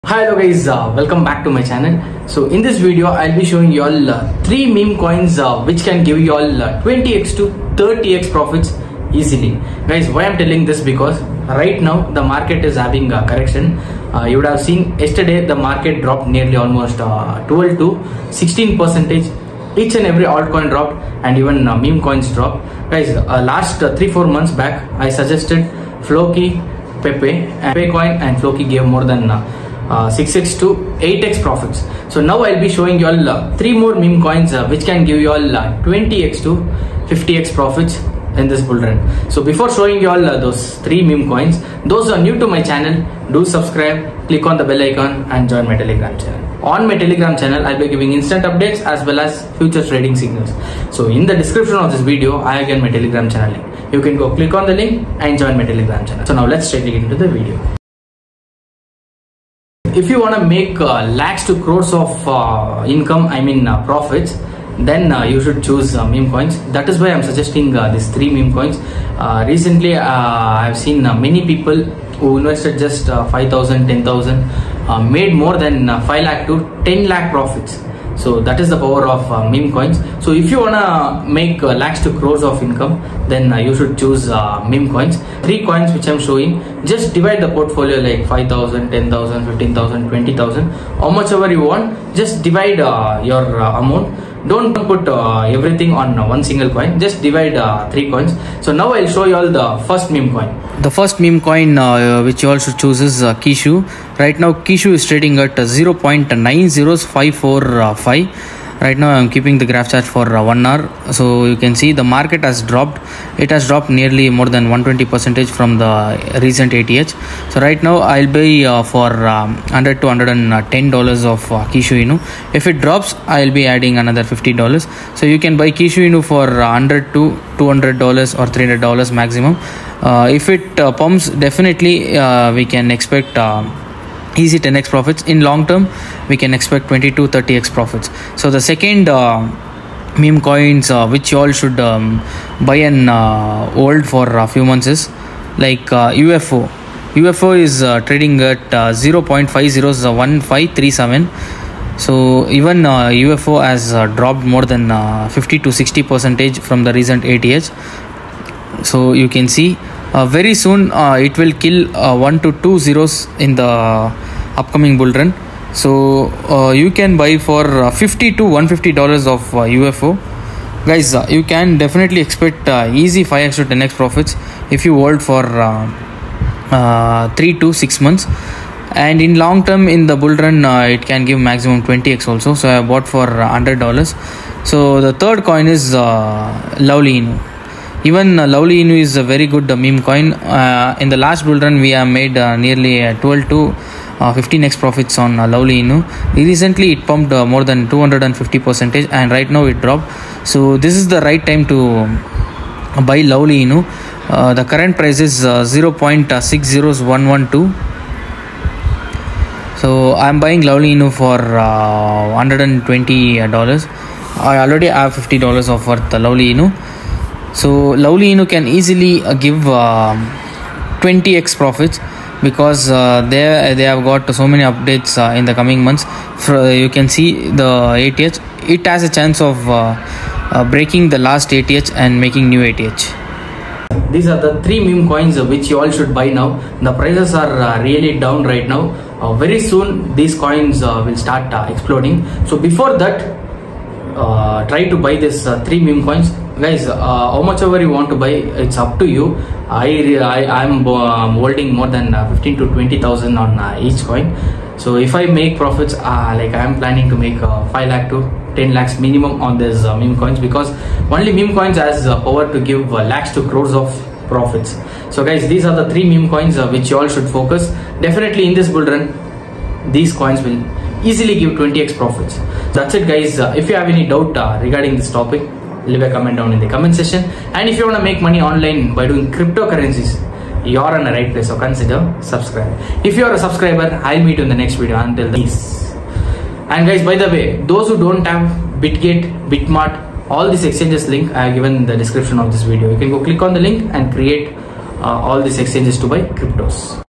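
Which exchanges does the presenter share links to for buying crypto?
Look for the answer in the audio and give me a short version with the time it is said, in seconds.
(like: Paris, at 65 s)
Bitget, at 288 s.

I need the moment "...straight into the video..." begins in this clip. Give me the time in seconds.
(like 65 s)
56 s.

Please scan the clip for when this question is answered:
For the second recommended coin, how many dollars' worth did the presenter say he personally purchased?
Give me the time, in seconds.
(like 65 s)
183 s.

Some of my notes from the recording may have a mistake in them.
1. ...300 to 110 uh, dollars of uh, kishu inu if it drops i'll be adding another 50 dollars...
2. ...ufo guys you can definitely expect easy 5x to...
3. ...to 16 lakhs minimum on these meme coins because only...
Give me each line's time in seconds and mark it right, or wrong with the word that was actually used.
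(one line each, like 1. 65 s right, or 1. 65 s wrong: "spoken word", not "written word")
1. 119 s wrong: "100", not "300"
2. 169 s right
3. 258 s wrong: "10", not "16".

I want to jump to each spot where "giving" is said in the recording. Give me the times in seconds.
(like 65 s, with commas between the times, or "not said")
47 s.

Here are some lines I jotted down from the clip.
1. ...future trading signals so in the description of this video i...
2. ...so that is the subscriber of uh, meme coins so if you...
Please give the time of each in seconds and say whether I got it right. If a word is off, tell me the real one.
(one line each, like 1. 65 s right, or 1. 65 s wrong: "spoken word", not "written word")
1. 49 s right
2. 78 s wrong: "power", not "subscriber".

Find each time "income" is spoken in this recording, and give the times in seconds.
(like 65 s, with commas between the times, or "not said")
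62 s, 82 s.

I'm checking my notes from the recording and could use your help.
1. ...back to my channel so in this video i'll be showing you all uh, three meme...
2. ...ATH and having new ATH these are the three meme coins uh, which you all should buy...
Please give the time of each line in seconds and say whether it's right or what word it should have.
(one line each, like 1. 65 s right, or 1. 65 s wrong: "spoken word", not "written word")
1. 1 s right
2. 231 s wrong: "making", not "having".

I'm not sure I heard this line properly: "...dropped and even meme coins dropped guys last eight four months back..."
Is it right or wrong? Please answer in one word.
wrong.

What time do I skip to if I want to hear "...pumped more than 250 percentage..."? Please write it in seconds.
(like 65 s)
197 s.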